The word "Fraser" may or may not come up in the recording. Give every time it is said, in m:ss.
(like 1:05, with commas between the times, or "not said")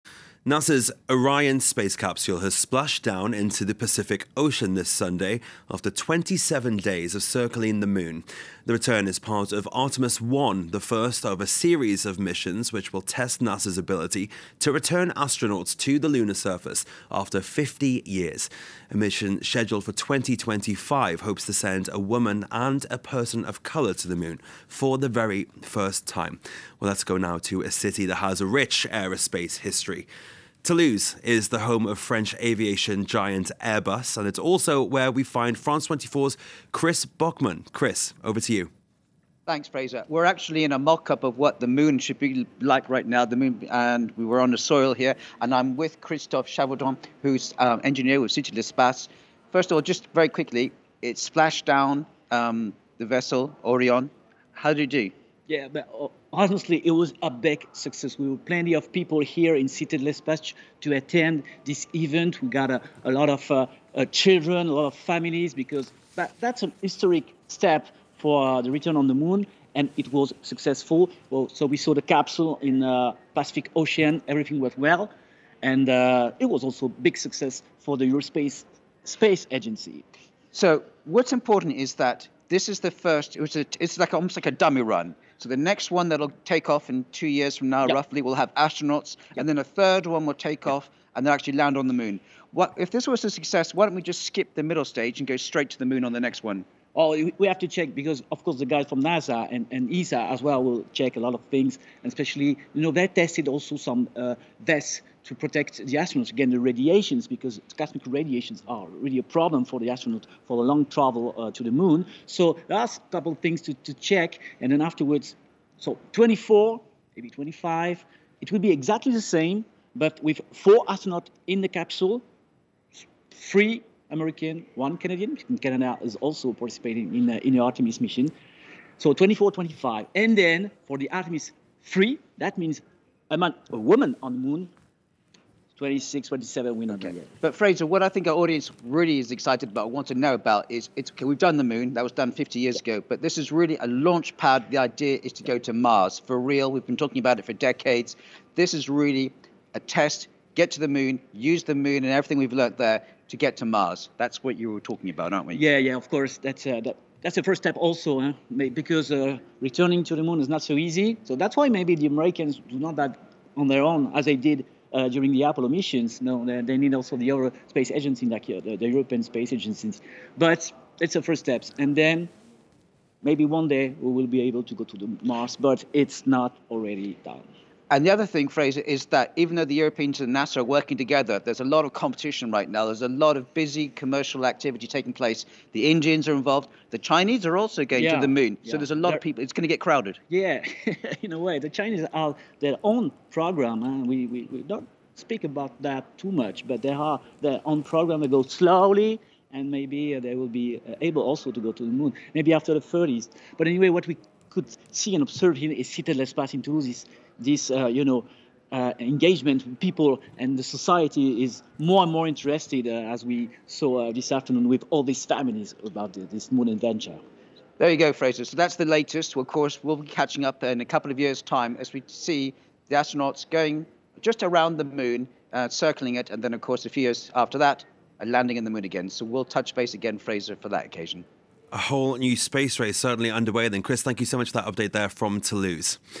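0:39, 2:17, 2:58, 3:38, 3:50.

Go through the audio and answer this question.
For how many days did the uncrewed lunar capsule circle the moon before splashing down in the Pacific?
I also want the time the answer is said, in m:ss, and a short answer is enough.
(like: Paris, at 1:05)
27, at 0:05.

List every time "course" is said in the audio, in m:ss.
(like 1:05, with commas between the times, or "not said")
1:38, 2:36, 3:39, 3:46.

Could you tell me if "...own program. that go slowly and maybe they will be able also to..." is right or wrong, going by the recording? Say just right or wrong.
right.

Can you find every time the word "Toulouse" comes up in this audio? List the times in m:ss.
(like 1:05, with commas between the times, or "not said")
0:30, 3:26, 3:55.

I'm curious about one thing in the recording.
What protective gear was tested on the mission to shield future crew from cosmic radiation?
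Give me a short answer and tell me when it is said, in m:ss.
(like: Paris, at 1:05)
vests, at 1:44.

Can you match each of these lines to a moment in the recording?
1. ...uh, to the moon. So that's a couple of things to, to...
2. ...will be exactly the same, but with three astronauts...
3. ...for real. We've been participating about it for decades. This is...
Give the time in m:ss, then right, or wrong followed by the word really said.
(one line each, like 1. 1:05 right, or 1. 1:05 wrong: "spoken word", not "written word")
1. 1:51 right
2. 1:58 wrong: "four", not "three"
3. 2:26 wrong: "talking", not "participating".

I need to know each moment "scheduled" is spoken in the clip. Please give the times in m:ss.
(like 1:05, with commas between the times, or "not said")
0:19.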